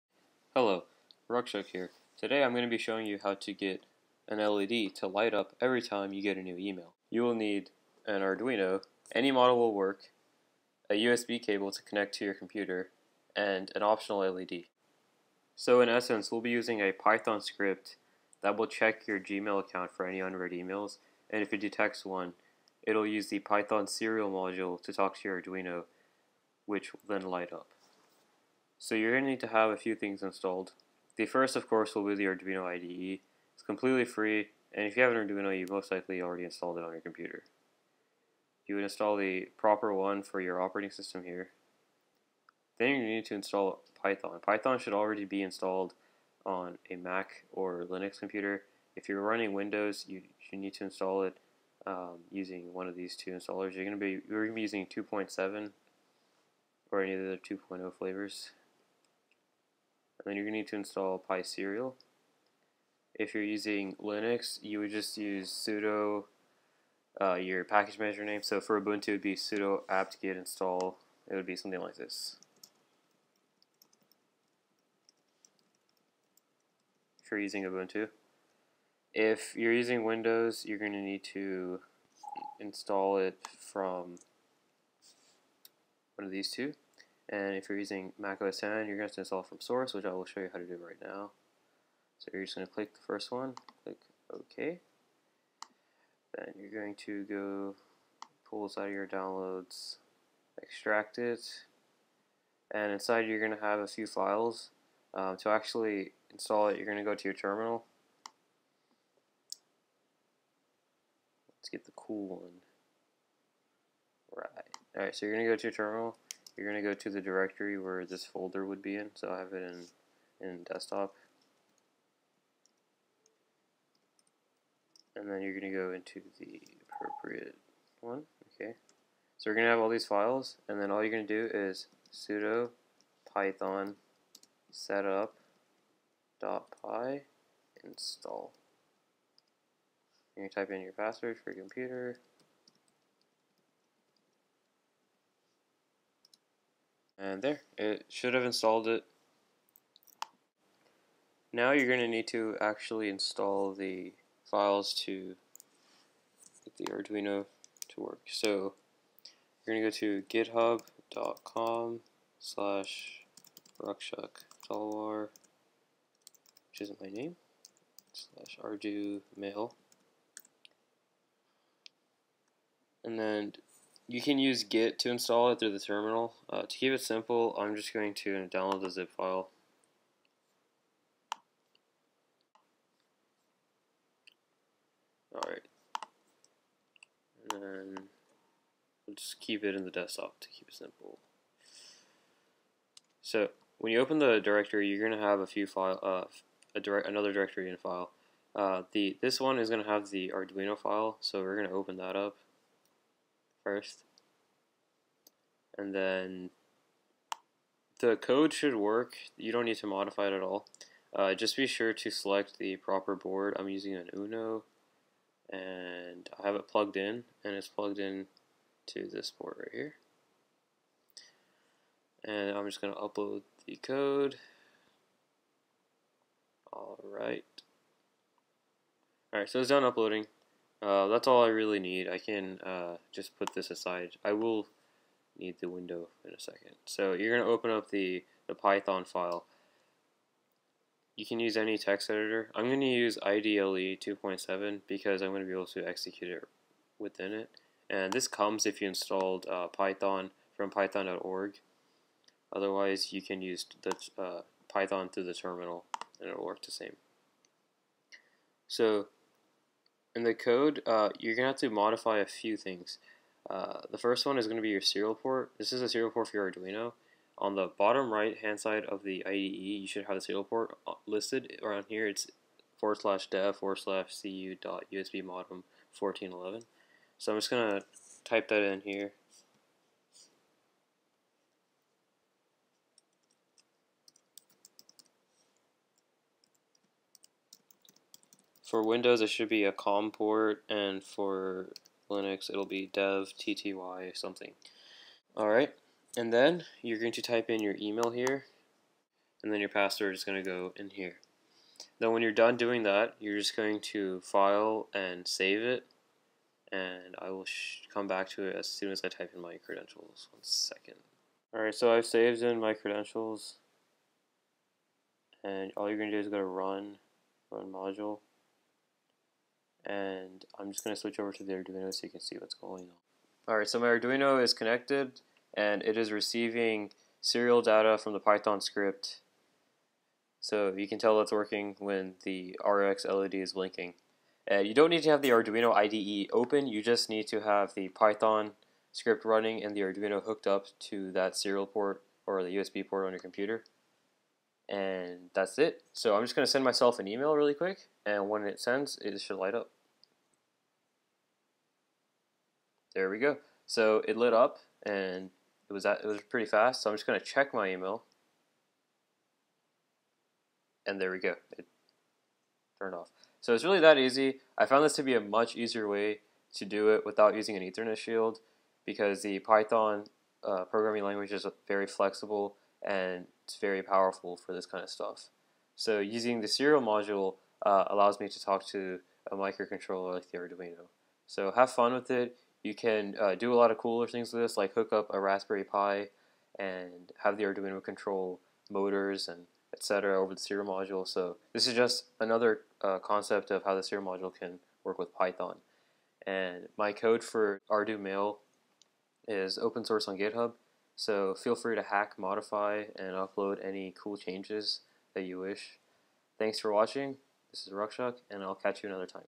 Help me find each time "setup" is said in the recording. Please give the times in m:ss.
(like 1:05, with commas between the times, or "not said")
2:14.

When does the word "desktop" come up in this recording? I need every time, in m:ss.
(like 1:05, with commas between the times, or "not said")
2:00, 3:09.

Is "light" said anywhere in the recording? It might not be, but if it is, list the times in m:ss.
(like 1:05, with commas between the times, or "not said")
0:05, 0:27, 5:49.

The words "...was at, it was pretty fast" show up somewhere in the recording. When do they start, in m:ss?
5:55.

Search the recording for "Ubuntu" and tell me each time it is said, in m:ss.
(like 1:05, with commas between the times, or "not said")
1:08, 1:17.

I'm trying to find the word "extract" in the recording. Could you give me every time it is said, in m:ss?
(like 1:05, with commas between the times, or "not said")
1:40.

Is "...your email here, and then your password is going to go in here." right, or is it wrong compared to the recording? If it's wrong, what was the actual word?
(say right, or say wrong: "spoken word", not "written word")
right.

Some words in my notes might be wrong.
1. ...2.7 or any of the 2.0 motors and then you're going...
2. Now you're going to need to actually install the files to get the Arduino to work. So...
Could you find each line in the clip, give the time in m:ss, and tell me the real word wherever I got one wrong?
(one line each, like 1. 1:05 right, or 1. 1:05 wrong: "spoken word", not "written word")
1. 0:54 wrong: "flavors", not "motors"
2. 2:31 right.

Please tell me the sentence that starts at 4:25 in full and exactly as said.
This is a serial port for your Arduino.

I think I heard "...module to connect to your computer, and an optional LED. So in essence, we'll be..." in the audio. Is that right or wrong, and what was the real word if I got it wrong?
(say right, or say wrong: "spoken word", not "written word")
wrong: "cable", not "module".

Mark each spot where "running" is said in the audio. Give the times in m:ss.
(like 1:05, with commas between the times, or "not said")
0:49, 5:39.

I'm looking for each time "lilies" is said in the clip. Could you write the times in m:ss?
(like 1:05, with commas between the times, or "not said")
not said.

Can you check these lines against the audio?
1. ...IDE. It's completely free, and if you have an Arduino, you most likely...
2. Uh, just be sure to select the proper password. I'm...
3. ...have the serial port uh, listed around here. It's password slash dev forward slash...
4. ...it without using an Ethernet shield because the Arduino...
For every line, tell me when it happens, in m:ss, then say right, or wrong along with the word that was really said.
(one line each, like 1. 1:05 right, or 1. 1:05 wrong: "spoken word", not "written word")
1. 0:32 right
2. 3:31 wrong: "board", not "password"
3. 4:30 wrong: "forward", not "password"
4. 6:06 wrong: "Python", not "Arduino".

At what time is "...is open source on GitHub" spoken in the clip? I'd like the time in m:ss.
6:39.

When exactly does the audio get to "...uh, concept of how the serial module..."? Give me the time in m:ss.
6:32.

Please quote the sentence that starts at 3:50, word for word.
Uh, that's all I really need.